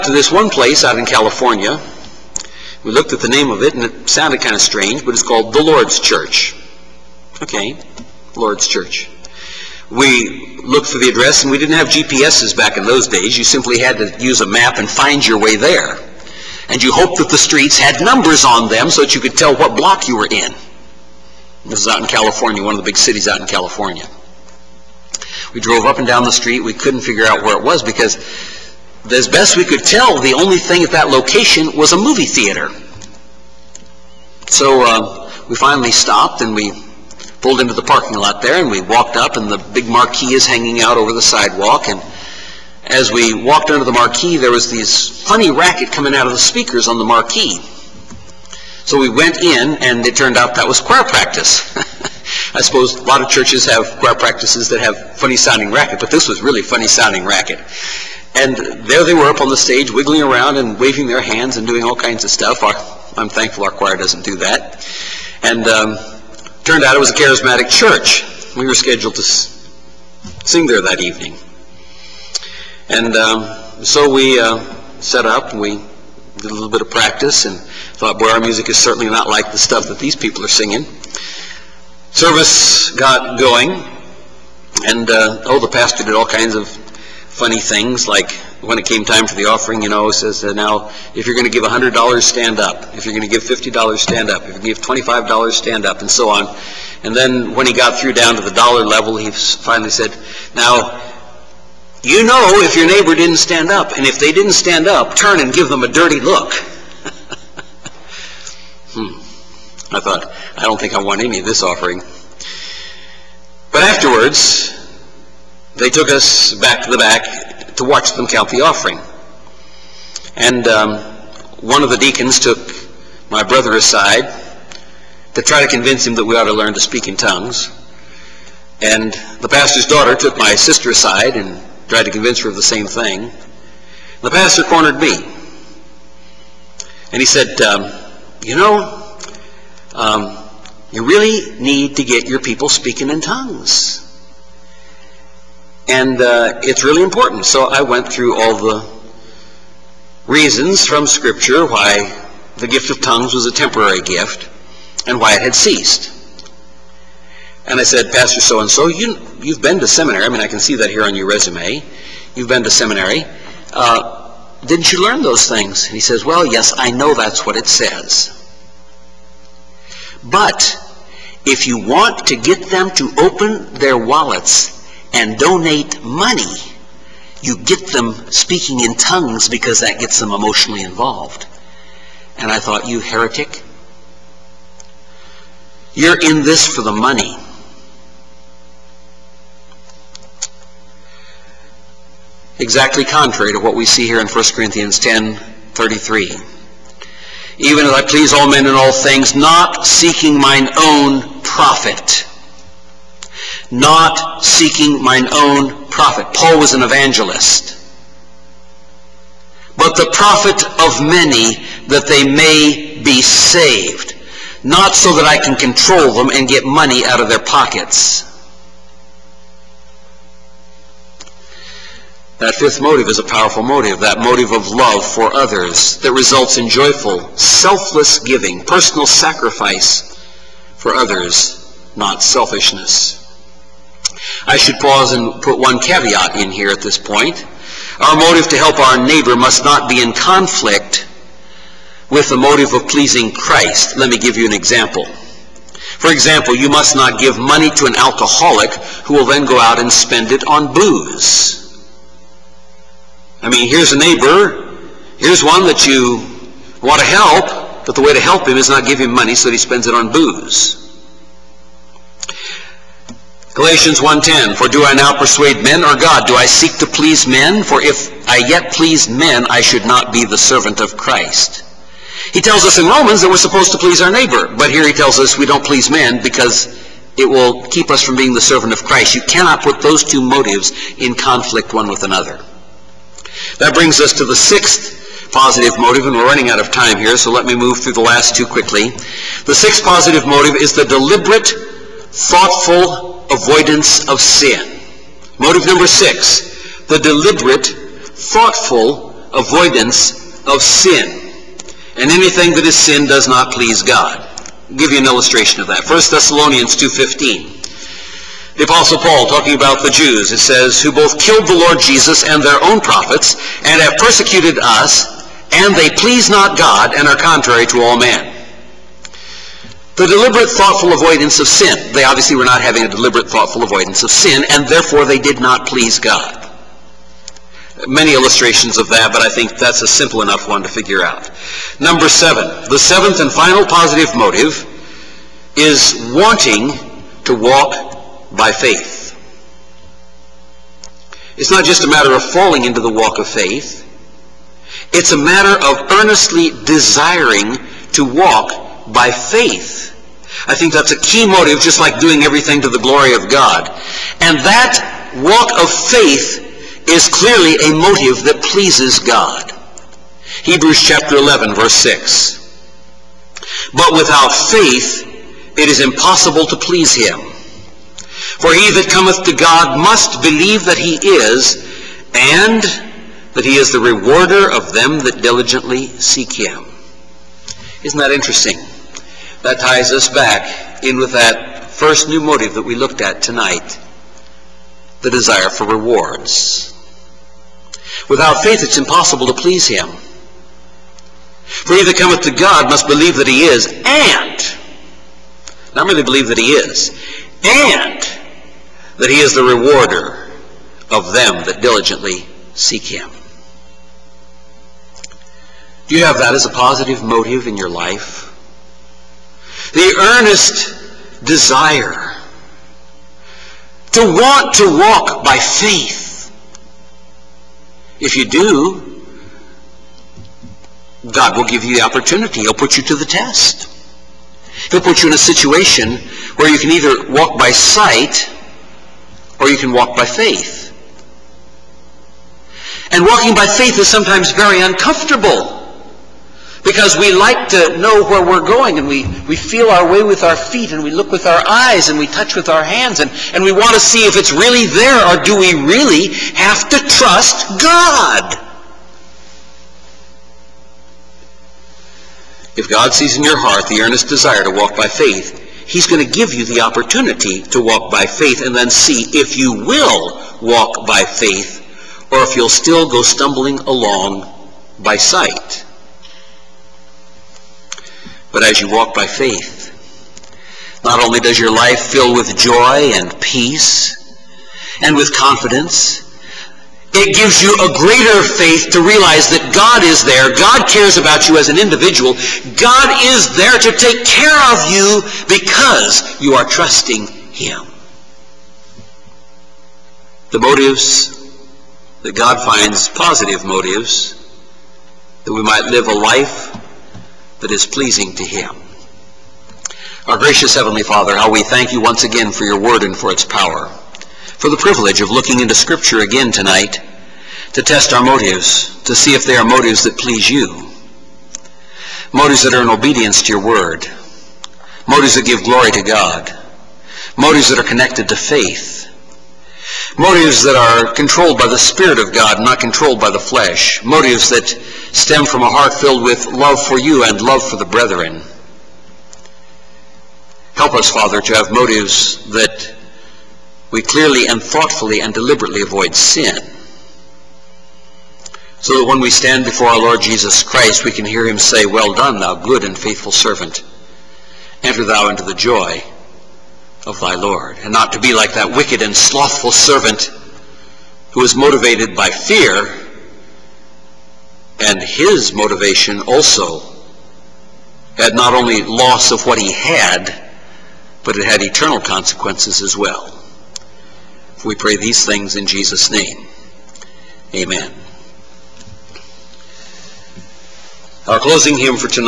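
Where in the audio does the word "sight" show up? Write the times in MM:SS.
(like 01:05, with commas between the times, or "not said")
07:07, 07:44.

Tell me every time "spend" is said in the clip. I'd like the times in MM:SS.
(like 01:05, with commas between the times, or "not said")
04:09, 04:19.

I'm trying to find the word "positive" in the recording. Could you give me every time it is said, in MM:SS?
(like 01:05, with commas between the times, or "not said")
04:45, 04:49, 05:33, 06:46, 08:12.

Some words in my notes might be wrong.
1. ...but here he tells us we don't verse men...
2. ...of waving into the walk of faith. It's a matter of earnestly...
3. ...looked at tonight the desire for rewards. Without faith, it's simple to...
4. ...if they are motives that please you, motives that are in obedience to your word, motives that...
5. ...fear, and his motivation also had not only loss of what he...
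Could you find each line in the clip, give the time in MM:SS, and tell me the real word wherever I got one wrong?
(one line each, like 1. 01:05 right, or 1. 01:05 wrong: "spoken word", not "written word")
1. 04:34 wrong: "please", not "verse"
2. 05:42 wrong: "falling", not "waving"
3. 06:22 wrong: "impossible", not "simple"
4. 08:29 right
5. 09:12 right.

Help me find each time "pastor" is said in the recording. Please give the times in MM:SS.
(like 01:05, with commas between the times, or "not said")
01:25, 02:09, 02:14, 02:38.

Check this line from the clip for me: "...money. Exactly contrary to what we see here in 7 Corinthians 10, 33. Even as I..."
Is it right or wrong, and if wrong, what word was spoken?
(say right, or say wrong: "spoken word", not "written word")
wrong: "1", not "7".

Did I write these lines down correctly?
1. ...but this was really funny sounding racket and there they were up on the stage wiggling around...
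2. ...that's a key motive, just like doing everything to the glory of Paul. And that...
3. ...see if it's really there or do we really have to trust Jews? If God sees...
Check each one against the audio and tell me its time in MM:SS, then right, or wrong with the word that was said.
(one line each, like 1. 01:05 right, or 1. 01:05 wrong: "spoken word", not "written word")
1. 00:55 right
2. 05:50 wrong: "God", not "Paul"
3. 07:23 wrong: "God", not "Jews".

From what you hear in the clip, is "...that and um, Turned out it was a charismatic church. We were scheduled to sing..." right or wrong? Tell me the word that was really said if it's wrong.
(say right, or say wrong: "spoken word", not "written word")
right.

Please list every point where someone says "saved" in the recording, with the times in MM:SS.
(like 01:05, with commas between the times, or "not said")
03:33.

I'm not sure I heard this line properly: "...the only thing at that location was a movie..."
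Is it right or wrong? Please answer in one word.
right.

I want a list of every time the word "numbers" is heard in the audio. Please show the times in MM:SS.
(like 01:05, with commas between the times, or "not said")
00:17, 04:55, 05:31.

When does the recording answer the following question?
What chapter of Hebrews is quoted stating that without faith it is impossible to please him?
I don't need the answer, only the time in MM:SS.
06:00.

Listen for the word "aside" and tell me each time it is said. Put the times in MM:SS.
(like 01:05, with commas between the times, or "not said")
02:03, 02:10.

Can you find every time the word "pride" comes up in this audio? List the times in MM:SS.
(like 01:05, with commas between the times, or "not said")
not said.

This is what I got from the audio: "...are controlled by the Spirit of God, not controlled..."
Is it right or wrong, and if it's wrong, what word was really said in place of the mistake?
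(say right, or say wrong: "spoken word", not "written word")
right.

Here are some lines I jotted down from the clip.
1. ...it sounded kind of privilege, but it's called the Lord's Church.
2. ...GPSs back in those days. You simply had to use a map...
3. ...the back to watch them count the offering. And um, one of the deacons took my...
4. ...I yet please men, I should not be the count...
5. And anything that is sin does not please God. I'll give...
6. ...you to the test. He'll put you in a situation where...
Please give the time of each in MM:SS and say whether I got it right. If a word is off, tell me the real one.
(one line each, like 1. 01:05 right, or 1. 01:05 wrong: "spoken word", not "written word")
1. 00:03 wrong: "strange", not "privilege"
2. 00:11 right
3. 01:56 right
4. 04:28 wrong: "servant", not "count"
5. 05:01 right
6. 07:02 right.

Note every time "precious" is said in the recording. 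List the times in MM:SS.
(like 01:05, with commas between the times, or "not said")
not said.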